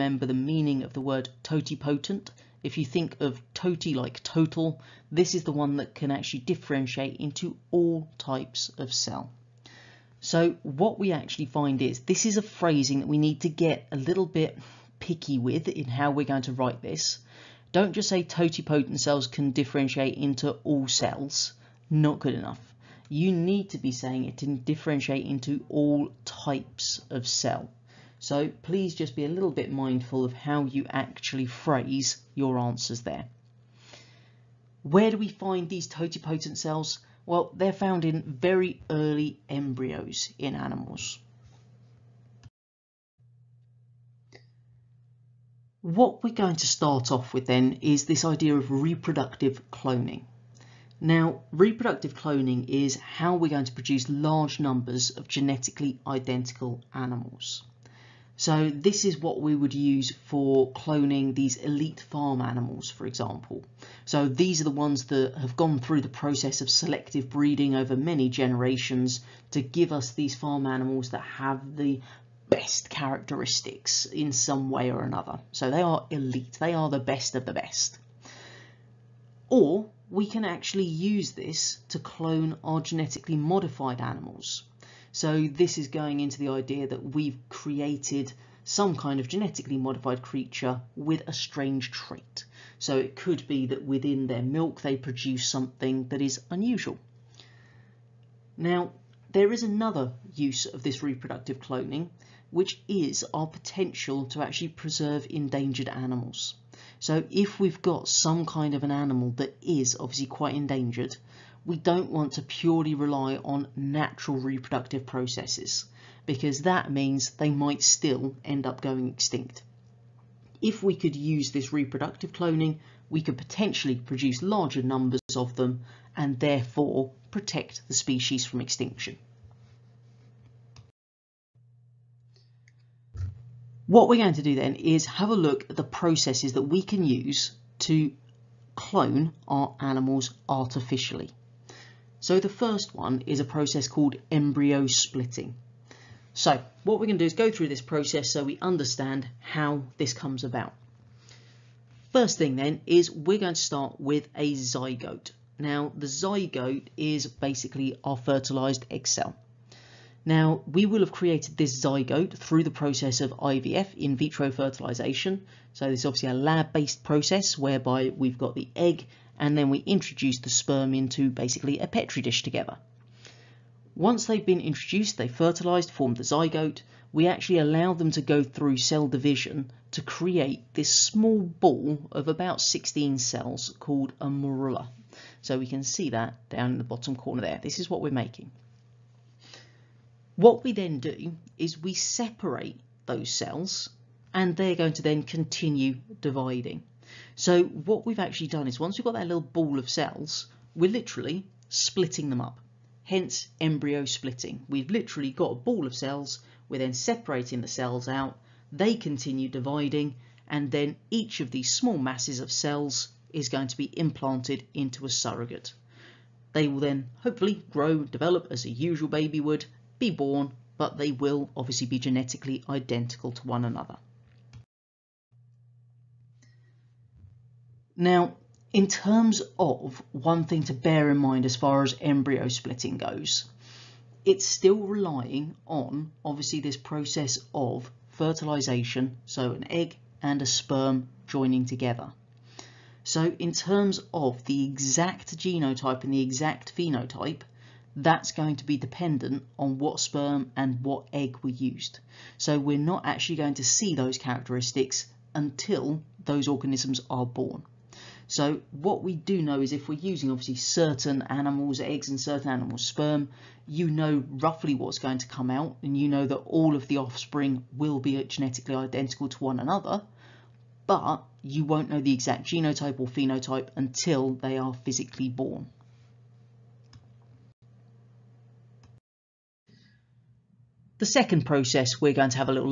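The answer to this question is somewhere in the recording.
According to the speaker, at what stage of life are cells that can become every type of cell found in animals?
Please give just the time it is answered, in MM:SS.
00:38.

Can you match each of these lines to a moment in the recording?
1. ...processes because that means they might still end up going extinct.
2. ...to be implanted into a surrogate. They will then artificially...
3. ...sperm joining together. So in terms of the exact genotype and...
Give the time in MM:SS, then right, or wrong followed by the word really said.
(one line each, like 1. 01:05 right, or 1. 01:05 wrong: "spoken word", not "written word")
1. 01:55 right
2. 03:33 wrong: "hopefully", not "artificially"
3. 04:00 right.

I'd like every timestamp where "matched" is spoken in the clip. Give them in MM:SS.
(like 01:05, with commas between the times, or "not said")
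not said.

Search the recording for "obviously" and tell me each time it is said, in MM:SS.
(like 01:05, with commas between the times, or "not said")
01:49, 02:46, 03:41, 03:56, 04:20.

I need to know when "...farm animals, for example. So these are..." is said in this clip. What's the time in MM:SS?
01:02.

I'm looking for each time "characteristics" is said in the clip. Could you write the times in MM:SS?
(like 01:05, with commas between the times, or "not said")
01:12, 04:14.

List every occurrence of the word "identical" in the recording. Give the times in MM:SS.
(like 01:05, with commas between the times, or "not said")
00:56, 03:42, 04:28.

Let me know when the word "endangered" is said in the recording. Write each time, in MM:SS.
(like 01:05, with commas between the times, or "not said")
01:45, 01:50.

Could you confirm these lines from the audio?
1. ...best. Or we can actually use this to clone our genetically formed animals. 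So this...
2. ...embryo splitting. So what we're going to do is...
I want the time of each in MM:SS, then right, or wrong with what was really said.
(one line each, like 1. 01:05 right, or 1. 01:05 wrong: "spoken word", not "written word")
1. 01:17 wrong: "modified", not "formed"
2. 02:24 right.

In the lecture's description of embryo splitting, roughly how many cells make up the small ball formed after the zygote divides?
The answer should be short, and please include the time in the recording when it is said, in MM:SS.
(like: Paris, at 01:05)
16, at 03:02.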